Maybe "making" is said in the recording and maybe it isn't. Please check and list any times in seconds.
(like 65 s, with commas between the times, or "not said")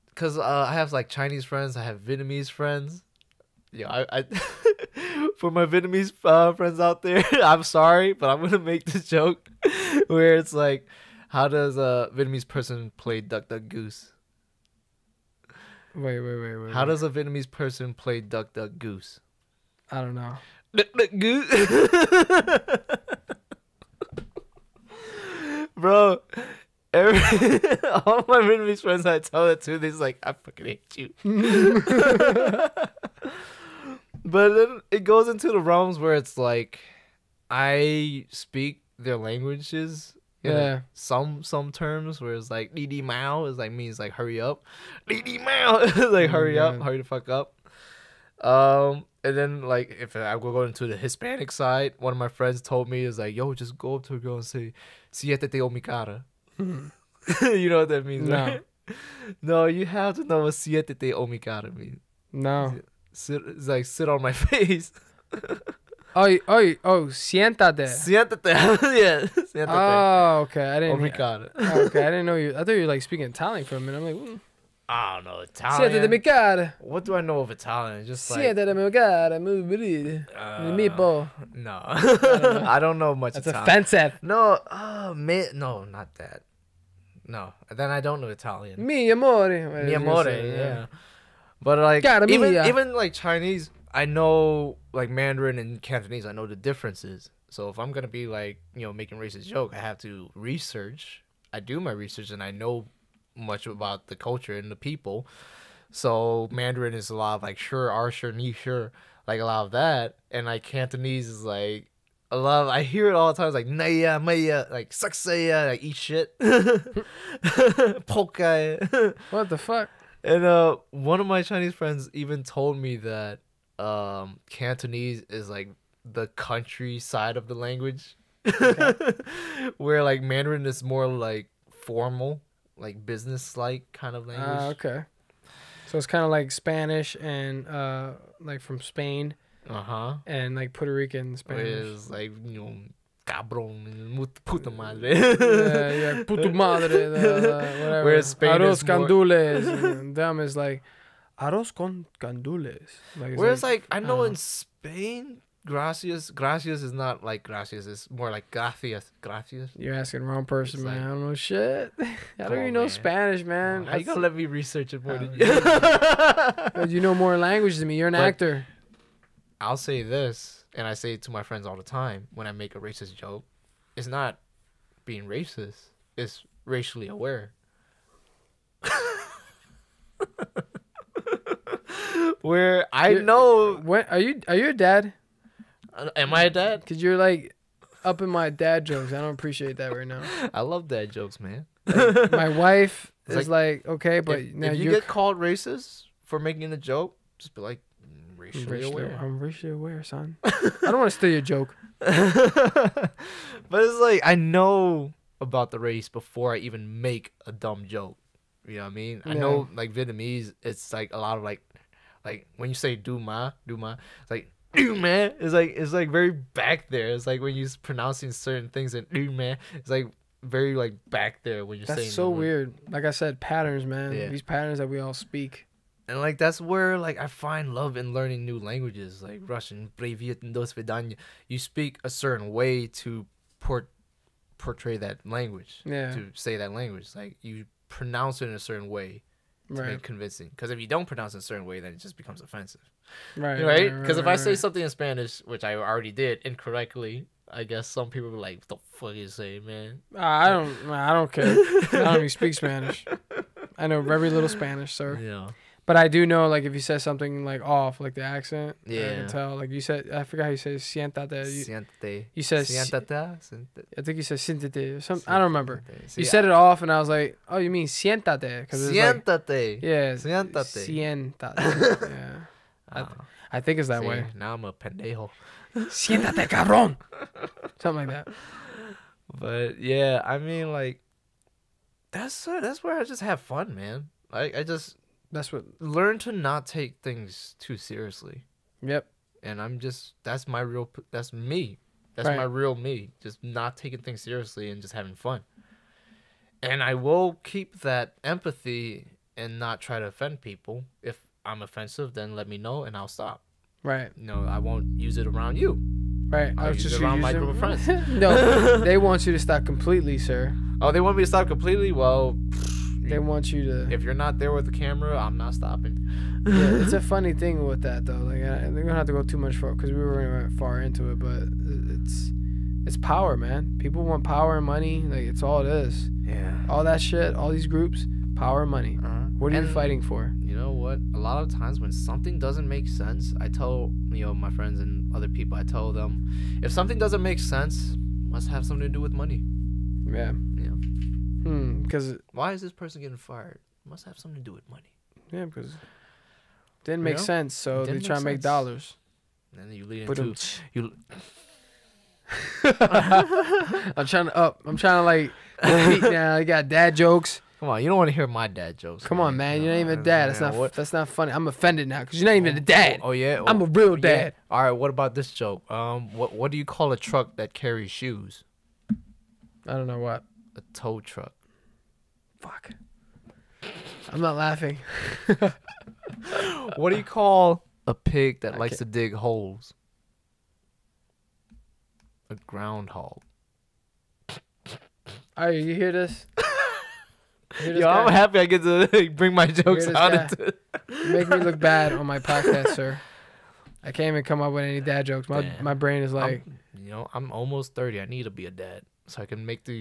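98 s, 196 s.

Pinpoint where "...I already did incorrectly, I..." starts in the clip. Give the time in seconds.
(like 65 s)
245 s.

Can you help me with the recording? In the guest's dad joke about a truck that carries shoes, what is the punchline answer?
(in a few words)
A tow truck.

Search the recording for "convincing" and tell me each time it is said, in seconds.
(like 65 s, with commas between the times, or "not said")
240 s.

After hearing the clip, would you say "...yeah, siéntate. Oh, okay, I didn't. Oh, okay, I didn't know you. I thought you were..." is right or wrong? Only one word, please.
right.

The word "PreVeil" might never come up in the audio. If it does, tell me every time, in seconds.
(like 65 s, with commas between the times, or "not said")
not said.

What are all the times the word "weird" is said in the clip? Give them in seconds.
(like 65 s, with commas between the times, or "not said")
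222 s.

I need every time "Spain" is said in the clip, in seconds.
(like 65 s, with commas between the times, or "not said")
138 s, 148 s, 154 s.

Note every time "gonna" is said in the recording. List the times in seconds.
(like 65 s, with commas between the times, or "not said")
8 s, 97 s, 164 s, 318 s.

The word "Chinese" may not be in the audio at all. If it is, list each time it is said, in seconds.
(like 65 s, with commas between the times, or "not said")
1 s, 93 s, 121 s.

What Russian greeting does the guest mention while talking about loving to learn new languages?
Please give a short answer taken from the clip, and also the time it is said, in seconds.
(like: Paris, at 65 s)
Privyet, at 229 s.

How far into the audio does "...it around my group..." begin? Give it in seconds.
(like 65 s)
307 s.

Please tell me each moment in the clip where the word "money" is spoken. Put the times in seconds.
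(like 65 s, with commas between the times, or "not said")
324 s, 328 s, 339 s, 344 s.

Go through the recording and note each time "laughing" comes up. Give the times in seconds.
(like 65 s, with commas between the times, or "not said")
374 s.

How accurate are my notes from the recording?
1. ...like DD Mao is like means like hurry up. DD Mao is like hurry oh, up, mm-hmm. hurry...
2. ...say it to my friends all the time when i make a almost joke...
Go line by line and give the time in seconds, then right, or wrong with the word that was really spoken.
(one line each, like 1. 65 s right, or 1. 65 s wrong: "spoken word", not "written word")
1. 42 s right
2. 170 s wrong: "racist", not "almost".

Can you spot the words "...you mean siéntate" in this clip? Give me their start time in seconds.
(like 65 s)
267 s.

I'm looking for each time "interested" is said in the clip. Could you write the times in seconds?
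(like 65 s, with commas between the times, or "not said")
not said.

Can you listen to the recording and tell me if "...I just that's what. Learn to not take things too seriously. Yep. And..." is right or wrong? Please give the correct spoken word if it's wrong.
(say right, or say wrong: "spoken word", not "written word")
right.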